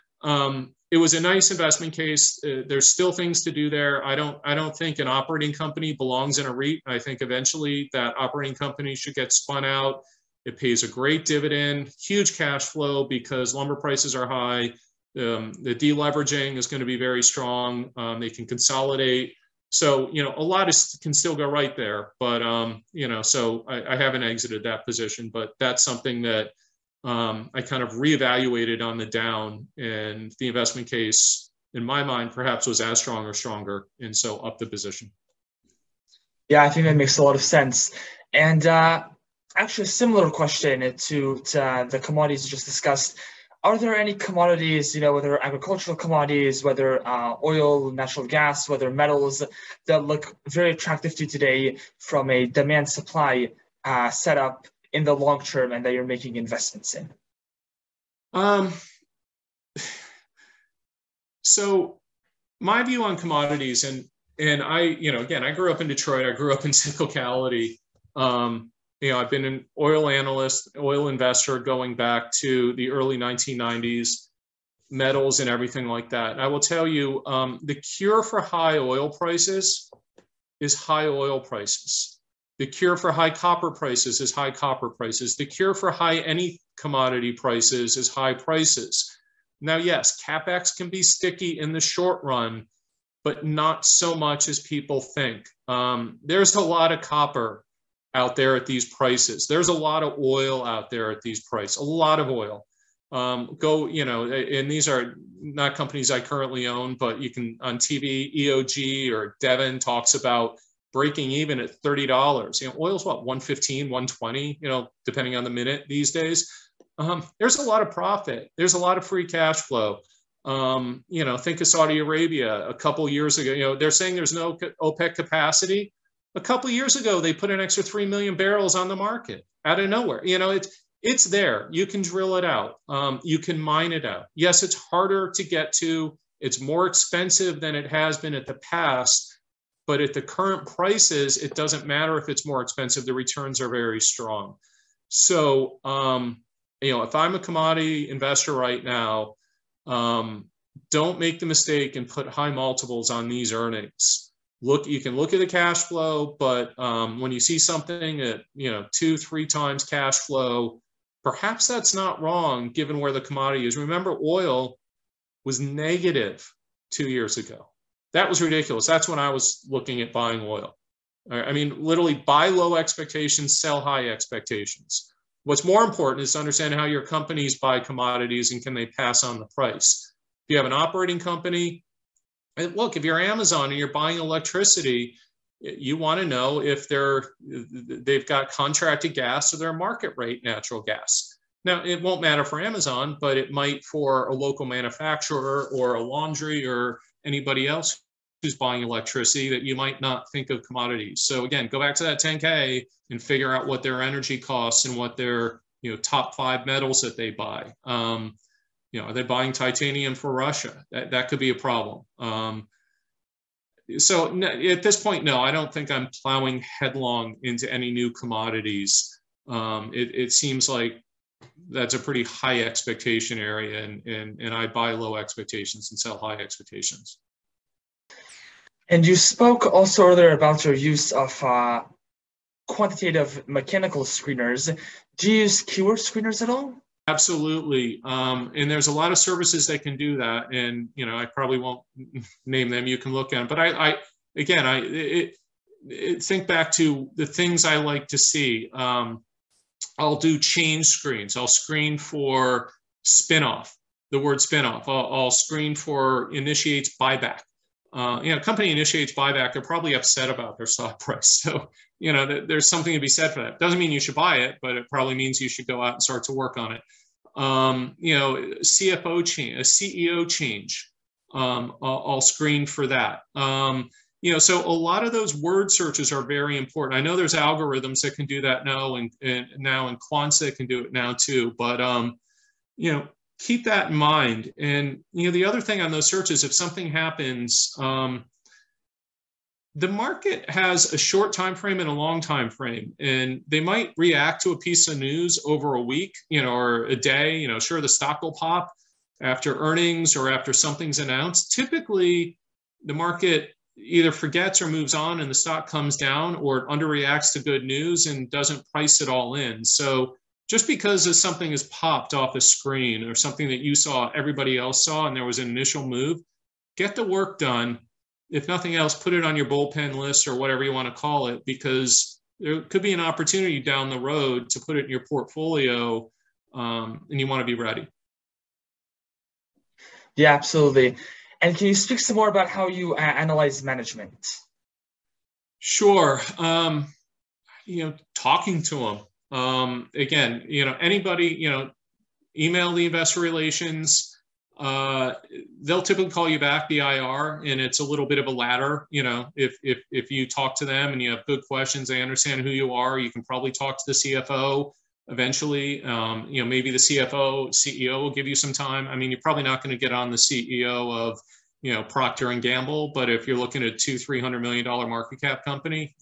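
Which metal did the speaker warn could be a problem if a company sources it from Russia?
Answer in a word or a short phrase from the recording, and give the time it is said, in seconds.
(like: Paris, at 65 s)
titanium, at 209 s.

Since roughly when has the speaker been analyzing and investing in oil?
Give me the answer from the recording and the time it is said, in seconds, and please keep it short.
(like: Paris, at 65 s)
early 1990s, at 72 s.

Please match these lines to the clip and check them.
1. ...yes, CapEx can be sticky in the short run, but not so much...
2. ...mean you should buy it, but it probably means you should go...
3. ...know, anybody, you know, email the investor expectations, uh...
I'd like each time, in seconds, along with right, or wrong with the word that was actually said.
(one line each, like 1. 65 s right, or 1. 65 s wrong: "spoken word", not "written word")
1. 89 s right
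2. 263 s right
3. 340 s wrong: "relations", not "expectations".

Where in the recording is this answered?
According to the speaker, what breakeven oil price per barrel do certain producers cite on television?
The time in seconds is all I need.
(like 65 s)
111 s.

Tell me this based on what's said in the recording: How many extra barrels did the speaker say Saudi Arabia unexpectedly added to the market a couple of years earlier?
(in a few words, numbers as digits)
3 million.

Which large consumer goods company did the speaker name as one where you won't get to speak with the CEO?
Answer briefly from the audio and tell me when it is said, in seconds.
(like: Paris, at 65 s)
Procter and Gamble, at 361 s.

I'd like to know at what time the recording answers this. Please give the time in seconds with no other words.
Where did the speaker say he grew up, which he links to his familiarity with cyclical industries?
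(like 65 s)
65 s.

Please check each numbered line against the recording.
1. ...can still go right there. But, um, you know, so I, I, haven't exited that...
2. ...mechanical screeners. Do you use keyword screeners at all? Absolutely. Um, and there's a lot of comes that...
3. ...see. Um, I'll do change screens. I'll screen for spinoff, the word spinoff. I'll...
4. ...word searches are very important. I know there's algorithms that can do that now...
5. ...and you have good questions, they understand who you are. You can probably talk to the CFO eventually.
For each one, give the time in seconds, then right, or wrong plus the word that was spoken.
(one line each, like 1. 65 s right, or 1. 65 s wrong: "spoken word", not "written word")
1. 21 s right
2. 233 s wrong: "services", not "comes"
3. 248 s right
4. 275 s right
5. 350 s right.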